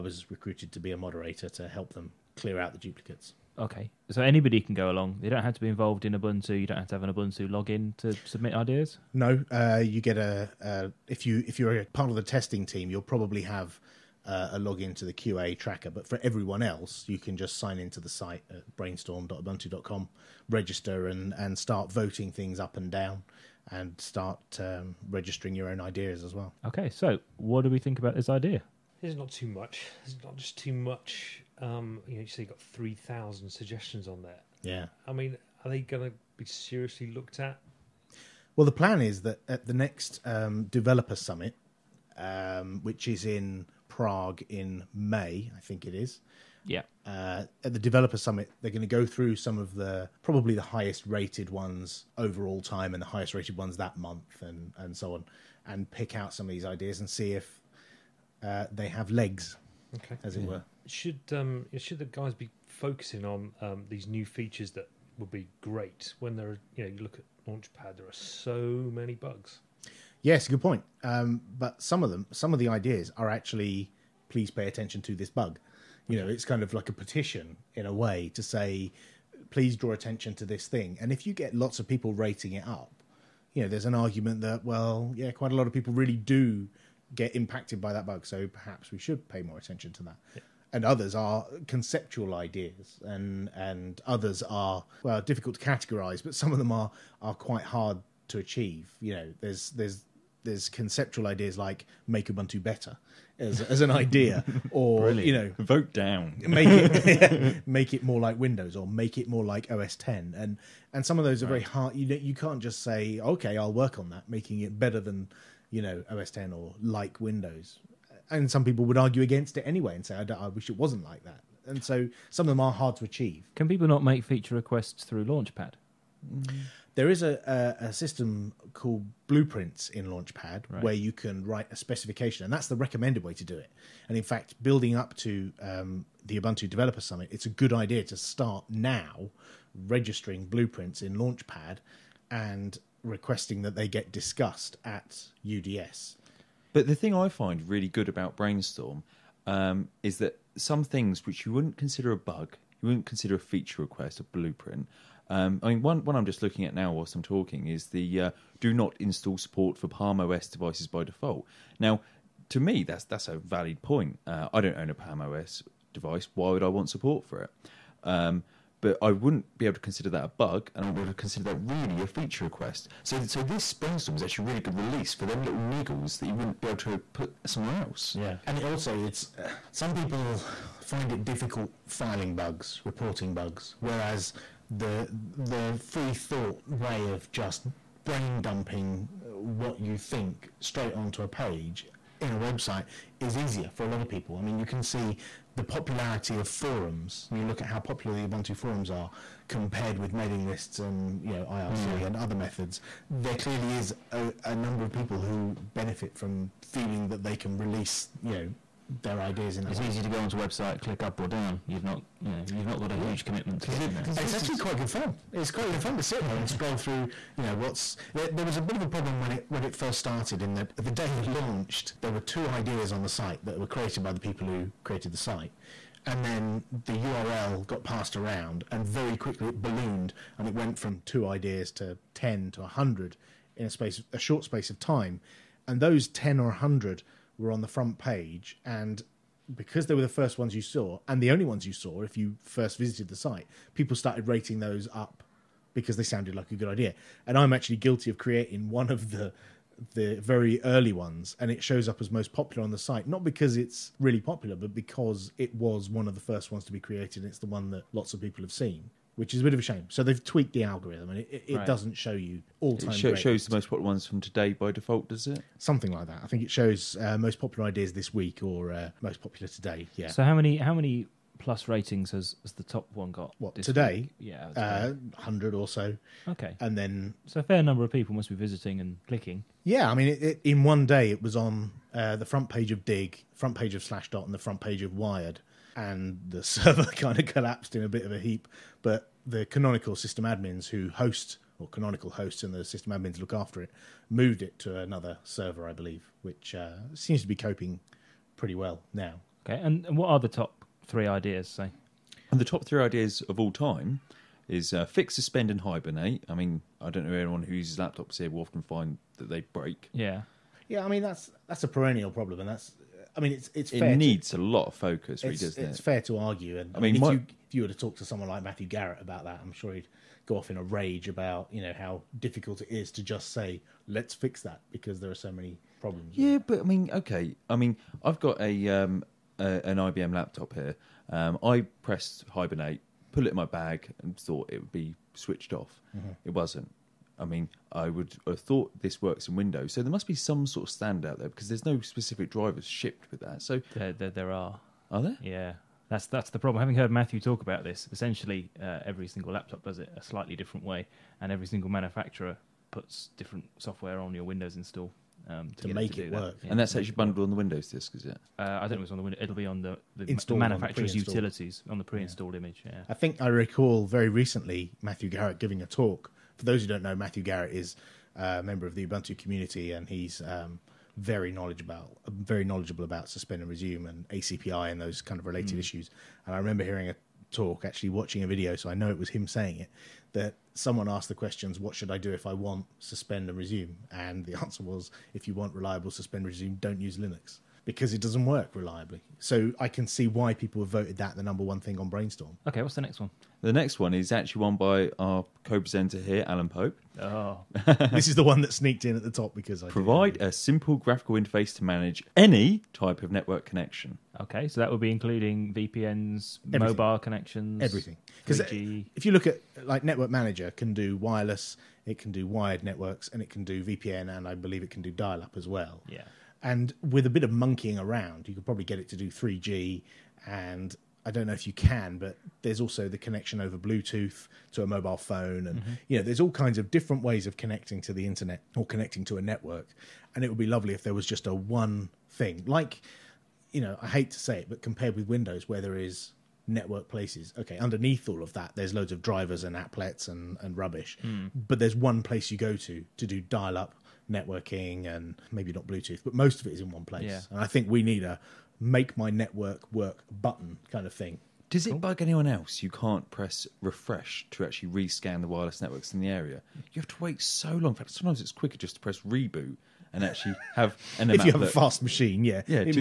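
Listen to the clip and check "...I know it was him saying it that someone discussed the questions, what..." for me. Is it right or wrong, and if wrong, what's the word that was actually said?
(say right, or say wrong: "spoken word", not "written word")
wrong: "asked", not "discussed".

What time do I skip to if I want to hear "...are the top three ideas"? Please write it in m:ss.
5:00.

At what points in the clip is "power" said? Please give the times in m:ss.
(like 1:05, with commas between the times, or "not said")
not said.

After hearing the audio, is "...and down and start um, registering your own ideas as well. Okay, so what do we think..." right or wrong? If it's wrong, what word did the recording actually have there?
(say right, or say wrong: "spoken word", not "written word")
right.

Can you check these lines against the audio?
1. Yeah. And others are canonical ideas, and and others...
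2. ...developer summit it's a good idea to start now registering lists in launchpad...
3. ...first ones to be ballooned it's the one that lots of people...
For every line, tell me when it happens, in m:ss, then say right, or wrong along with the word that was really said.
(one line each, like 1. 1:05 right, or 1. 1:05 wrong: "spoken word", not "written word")
1. 1:30 wrong: "conceptual", not "canonical"
2. 2:16 wrong: "blueprints", not "lists"
3. 4:16 wrong: "created", not "ballooned".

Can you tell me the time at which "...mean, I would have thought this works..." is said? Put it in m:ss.
5:37.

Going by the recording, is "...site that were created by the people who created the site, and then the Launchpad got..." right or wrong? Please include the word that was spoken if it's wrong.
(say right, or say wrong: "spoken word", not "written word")
wrong: "URL", not "Launchpad".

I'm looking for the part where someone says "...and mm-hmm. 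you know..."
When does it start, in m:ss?
7:05.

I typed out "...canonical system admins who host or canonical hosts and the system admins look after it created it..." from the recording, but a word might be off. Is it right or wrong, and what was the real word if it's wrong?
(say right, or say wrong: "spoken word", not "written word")
wrong: "moved", not "created".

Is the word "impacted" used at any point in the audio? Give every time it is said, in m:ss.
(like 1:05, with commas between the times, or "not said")
1:27.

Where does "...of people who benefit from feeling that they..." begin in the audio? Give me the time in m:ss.
3:24.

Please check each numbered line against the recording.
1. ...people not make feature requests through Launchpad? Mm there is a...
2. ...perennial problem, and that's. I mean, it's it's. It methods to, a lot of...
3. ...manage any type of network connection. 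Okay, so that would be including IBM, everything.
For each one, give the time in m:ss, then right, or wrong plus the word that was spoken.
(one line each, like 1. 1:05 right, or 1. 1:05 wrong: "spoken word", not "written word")
1. 2:03 right
2. 5:11 wrong: "needs", not "methods"
3. 6:41 wrong: "VPNs", not "IBM".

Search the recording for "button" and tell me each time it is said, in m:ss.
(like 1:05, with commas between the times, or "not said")
7:30.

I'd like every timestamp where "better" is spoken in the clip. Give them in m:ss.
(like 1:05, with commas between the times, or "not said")
1:42, 1:54.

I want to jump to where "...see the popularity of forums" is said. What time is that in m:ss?
3:14.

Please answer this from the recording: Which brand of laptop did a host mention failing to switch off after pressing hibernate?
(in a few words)
IBM.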